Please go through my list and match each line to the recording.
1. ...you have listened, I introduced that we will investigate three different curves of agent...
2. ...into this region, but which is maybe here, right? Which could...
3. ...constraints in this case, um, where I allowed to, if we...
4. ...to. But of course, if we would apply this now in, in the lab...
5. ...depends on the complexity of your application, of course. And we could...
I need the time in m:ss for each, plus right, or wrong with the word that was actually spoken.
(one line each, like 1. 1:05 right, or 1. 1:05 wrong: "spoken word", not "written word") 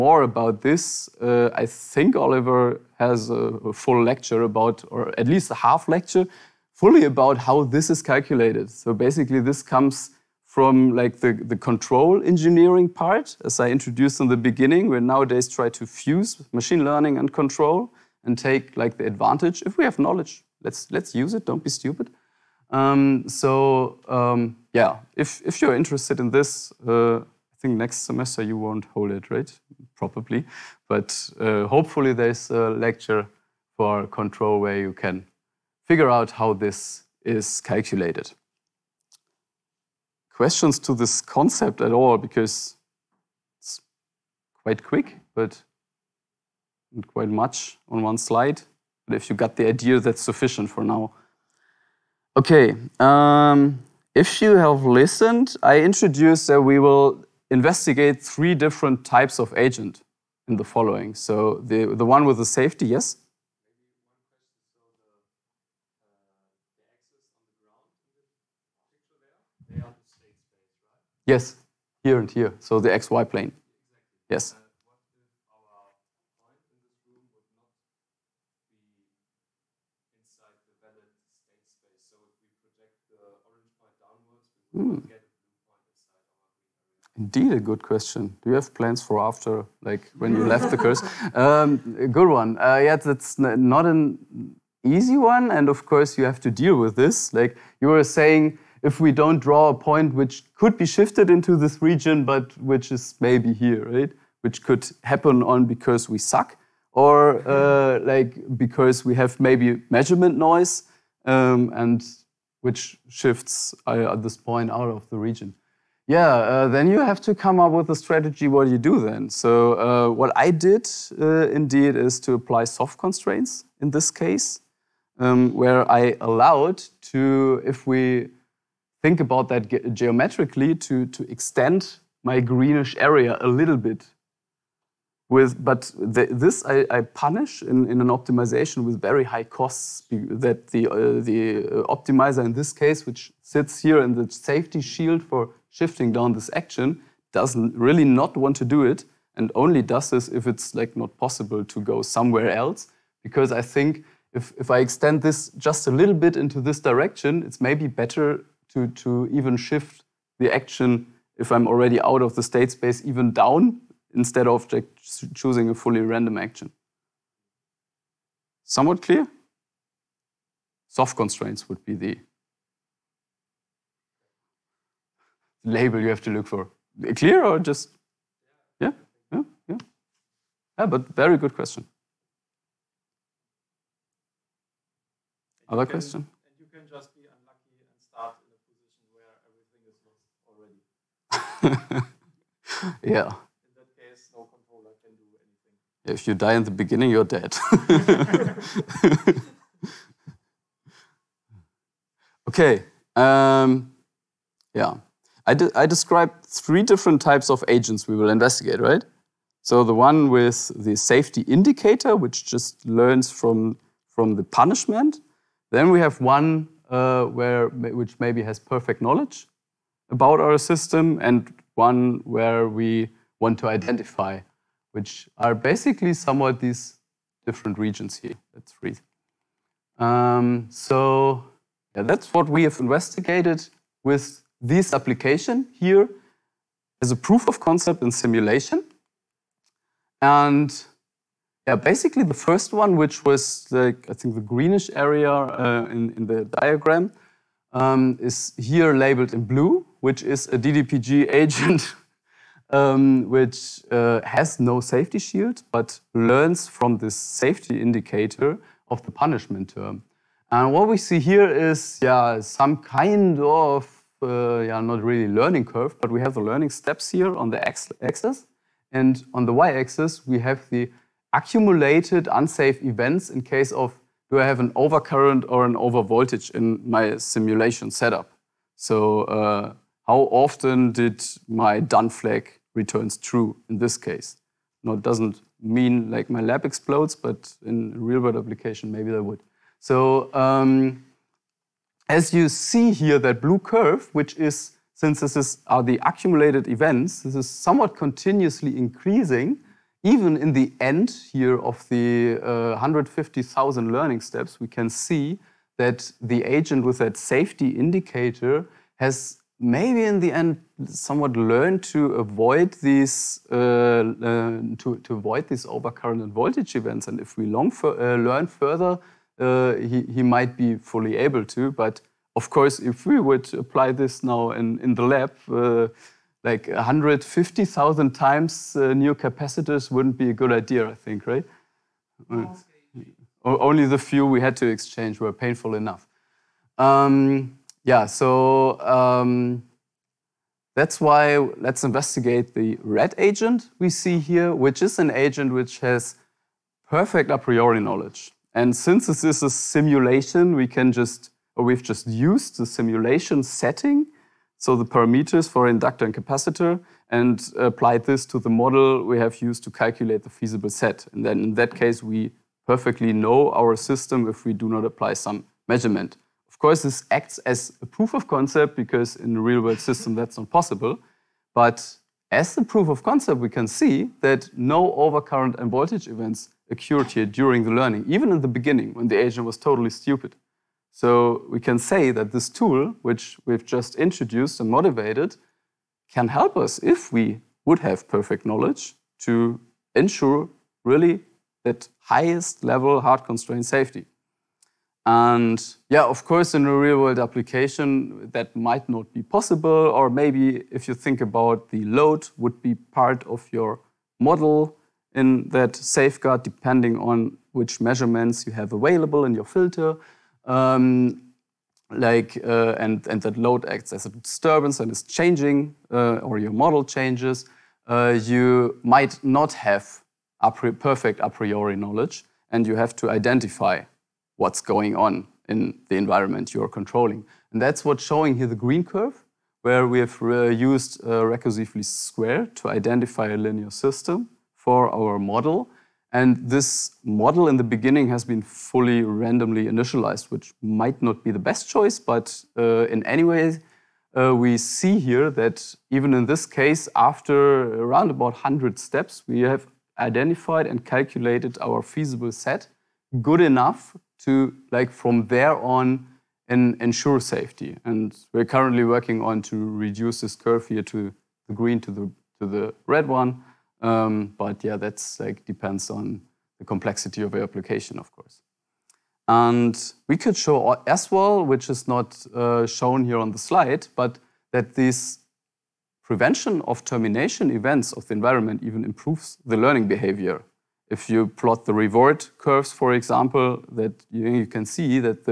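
1. 0:54 wrong: "types", not "curves"
2. 1:41 right
3. 2:02 right
4. 5:21 right
5. 7:45 right.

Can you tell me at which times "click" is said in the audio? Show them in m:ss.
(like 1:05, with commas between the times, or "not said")
not said.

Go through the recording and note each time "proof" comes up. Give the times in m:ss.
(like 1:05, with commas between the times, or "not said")
3:57, 6:07, 6:12.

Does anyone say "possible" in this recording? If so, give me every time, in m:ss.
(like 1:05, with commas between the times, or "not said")
2:31, 6:10, 6:39.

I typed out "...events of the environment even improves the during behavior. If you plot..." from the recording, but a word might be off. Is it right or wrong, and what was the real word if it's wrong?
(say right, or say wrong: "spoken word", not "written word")
wrong: "learning", not "during".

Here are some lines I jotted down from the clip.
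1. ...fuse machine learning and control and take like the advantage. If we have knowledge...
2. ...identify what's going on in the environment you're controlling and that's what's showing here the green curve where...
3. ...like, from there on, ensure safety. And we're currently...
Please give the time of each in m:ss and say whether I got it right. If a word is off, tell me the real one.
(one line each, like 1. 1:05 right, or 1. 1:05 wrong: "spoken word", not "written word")
1. 0:15 right
2. 7:03 right
3. 7:34 right.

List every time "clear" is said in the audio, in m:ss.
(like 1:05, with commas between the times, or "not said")
2:49, 2:57.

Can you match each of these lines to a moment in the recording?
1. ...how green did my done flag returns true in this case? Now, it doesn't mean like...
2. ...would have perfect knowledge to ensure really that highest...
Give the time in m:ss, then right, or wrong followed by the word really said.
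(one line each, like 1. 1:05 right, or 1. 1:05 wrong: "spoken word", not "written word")
1. 4:40 wrong: "often", not "green"
2. 6:27 right.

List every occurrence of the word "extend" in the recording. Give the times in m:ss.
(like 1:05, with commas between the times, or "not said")
2:11, 2:34.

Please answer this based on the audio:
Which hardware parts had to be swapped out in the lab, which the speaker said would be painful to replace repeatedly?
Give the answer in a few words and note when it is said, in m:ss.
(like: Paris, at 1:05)
Capacitors, at 5:29.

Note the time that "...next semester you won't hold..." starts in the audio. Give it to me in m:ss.
0:27.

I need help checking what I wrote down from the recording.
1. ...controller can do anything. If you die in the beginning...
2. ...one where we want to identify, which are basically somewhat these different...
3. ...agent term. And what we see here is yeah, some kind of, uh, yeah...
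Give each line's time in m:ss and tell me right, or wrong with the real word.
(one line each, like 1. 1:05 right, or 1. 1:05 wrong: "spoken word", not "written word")
1. 3:14 right
2. 3:41 right
3. 4:19 wrong: "punishment", not "agent".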